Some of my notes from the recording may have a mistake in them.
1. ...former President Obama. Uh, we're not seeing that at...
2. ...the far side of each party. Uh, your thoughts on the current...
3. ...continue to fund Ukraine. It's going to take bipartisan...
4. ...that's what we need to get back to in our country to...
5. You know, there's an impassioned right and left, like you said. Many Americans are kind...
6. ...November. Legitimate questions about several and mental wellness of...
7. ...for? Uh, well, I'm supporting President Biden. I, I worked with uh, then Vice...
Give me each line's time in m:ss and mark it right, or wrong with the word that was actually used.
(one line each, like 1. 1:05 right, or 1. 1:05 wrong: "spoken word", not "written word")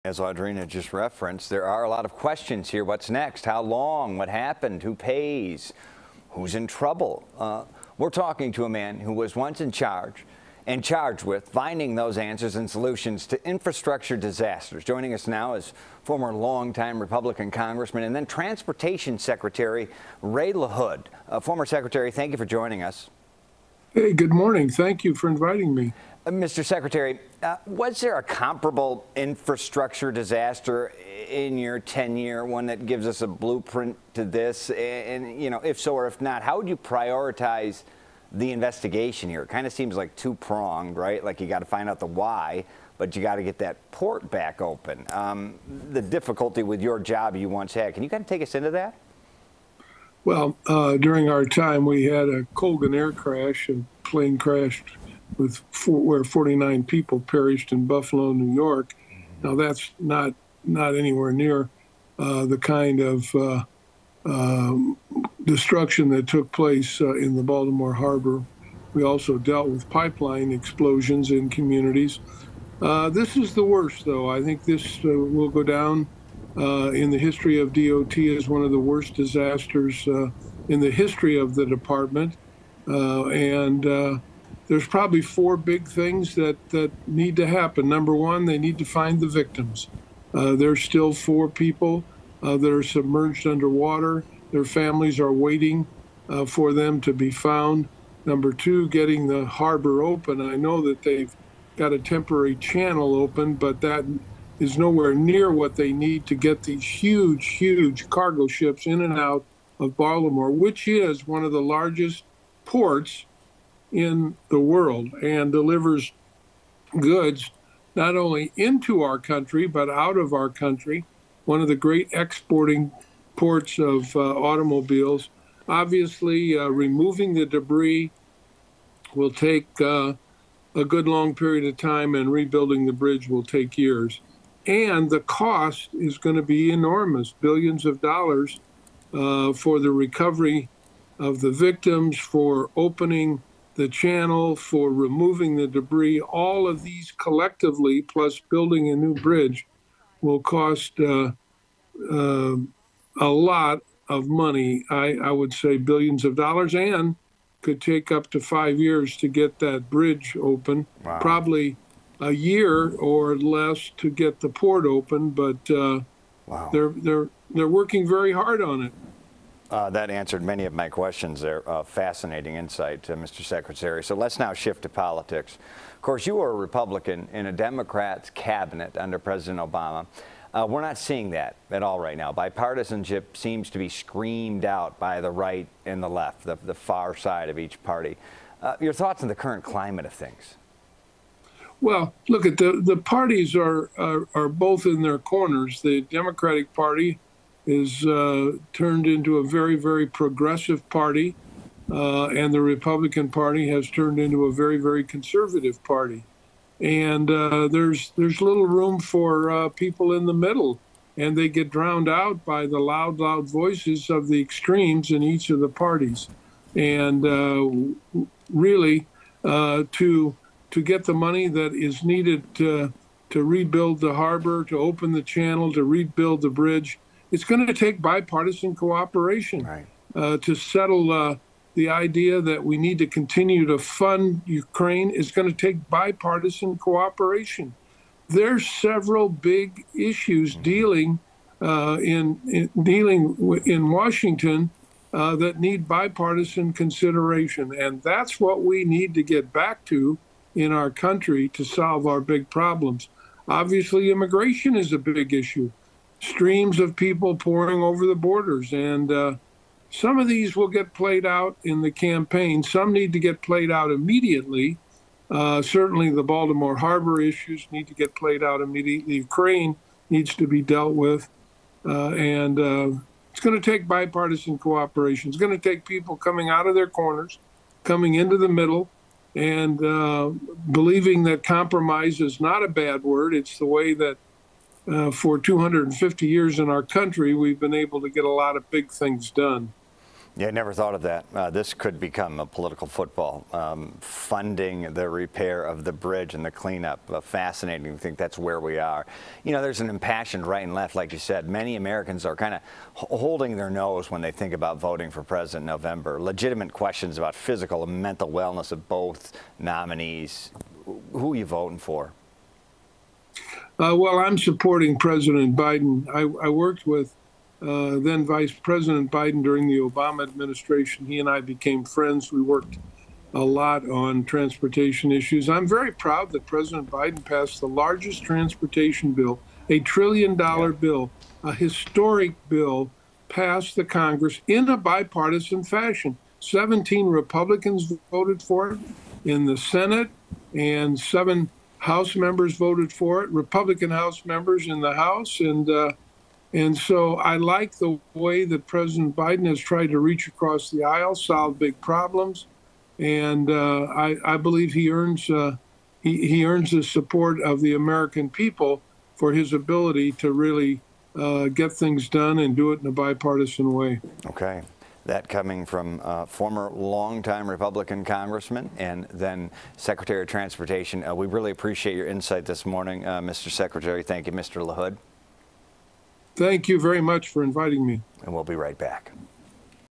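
1. 2:58 wrong: "under", not "former"
2. 3:06 right
3. 3:53 right
4. 4:08 right
5. 4:59 right
6. 5:05 wrong: "physical", not "several"
7. 5:11 right.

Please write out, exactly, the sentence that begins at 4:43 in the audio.
It's the way that uh, for 250 years in our country, we've been able to get a lot of big things done.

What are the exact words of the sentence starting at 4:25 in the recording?
Uh, certainly, the Baltimore Harbor issues need to get played out immediately.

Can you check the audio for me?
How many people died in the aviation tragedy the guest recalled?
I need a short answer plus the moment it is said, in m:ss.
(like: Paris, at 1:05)
49, at 0:56.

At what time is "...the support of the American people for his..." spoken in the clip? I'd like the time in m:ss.
5:56.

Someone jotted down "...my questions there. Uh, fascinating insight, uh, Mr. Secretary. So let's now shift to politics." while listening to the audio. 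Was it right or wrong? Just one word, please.
right.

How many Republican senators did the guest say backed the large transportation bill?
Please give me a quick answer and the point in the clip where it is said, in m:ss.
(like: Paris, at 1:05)
17, at 5:36.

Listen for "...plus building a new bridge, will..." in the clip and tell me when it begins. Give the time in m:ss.
2:28.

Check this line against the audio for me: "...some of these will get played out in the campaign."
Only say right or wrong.
right.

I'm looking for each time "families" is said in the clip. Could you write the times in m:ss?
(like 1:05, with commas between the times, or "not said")
1:34.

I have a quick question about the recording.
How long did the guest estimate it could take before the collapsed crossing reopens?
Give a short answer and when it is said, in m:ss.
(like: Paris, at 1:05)
5 years, at 2:38.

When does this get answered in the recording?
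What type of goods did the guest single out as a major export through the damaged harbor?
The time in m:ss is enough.
2:04.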